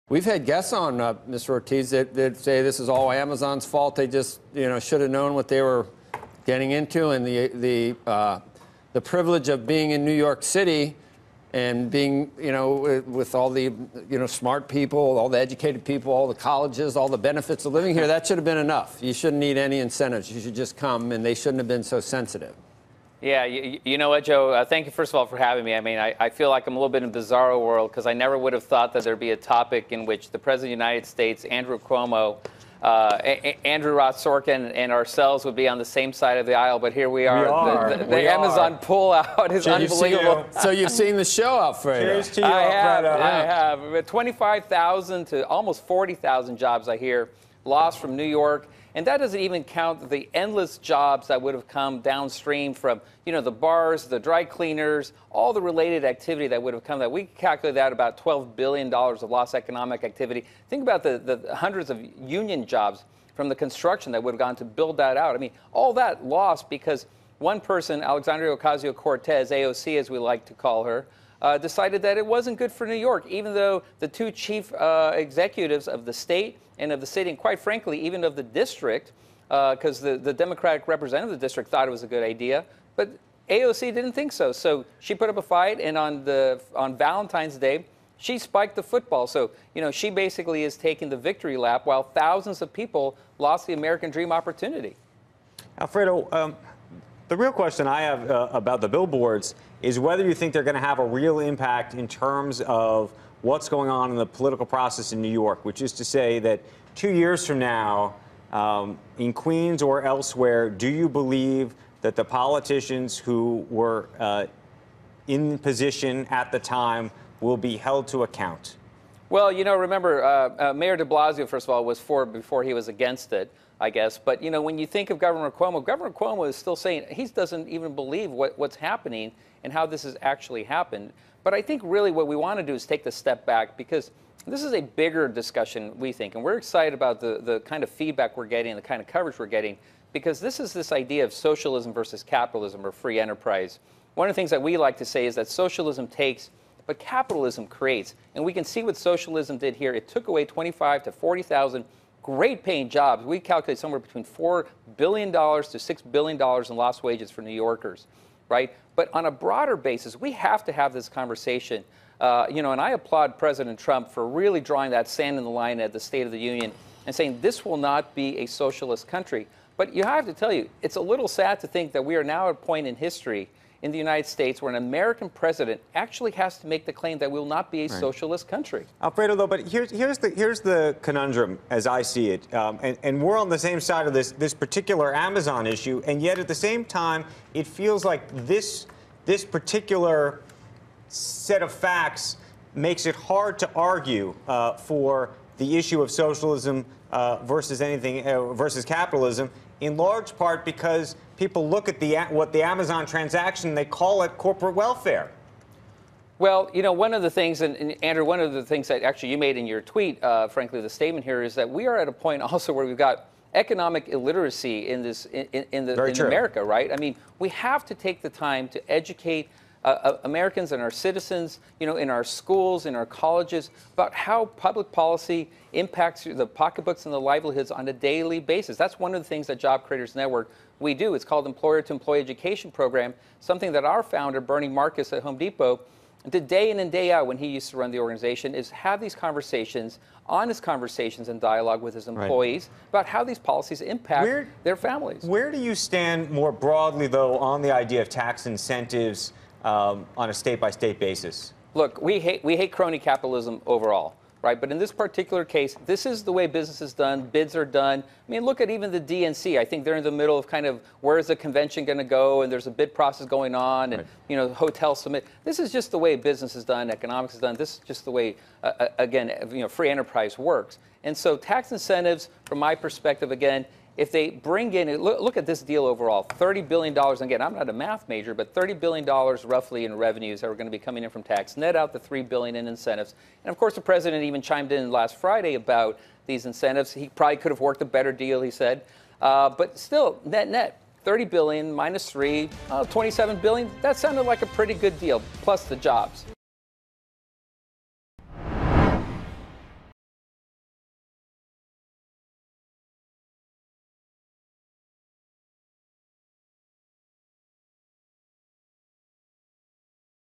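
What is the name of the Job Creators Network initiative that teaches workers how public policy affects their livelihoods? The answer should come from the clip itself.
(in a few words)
Employer to Employee Education Program.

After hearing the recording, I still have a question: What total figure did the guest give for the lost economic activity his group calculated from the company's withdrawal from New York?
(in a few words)
$12 billion.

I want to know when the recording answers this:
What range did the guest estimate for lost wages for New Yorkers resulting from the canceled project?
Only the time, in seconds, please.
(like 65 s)
154 s.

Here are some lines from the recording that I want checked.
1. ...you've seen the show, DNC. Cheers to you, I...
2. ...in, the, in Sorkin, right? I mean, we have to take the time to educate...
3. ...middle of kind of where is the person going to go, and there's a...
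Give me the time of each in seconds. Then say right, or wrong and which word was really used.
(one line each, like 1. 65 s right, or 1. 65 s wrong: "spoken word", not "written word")
1. 40 s wrong: "Alfredo", not "DNC"
2. 215 s wrong: "America", not "Sorkin"
3. 260 s wrong: "convention", not "person".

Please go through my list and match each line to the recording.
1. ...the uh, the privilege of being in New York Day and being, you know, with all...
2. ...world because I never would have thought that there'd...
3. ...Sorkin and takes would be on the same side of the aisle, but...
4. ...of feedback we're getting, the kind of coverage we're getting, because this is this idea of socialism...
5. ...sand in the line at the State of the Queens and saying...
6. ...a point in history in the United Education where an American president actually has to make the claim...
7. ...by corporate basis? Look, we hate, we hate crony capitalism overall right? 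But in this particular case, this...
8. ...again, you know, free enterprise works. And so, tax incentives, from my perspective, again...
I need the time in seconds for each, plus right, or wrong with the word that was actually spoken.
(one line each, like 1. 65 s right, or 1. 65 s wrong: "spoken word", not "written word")
1. 7 s wrong: "City", not "Day"
2. 27 s right
3. 34 s wrong: "ourselves", not "takes"
4. 137 s right
5. 165 s wrong: "Union", not "Queens"
6. 172 s wrong: "States", not "Education"
7. 250 s wrong: "state", not "corporate"
8. 268 s right.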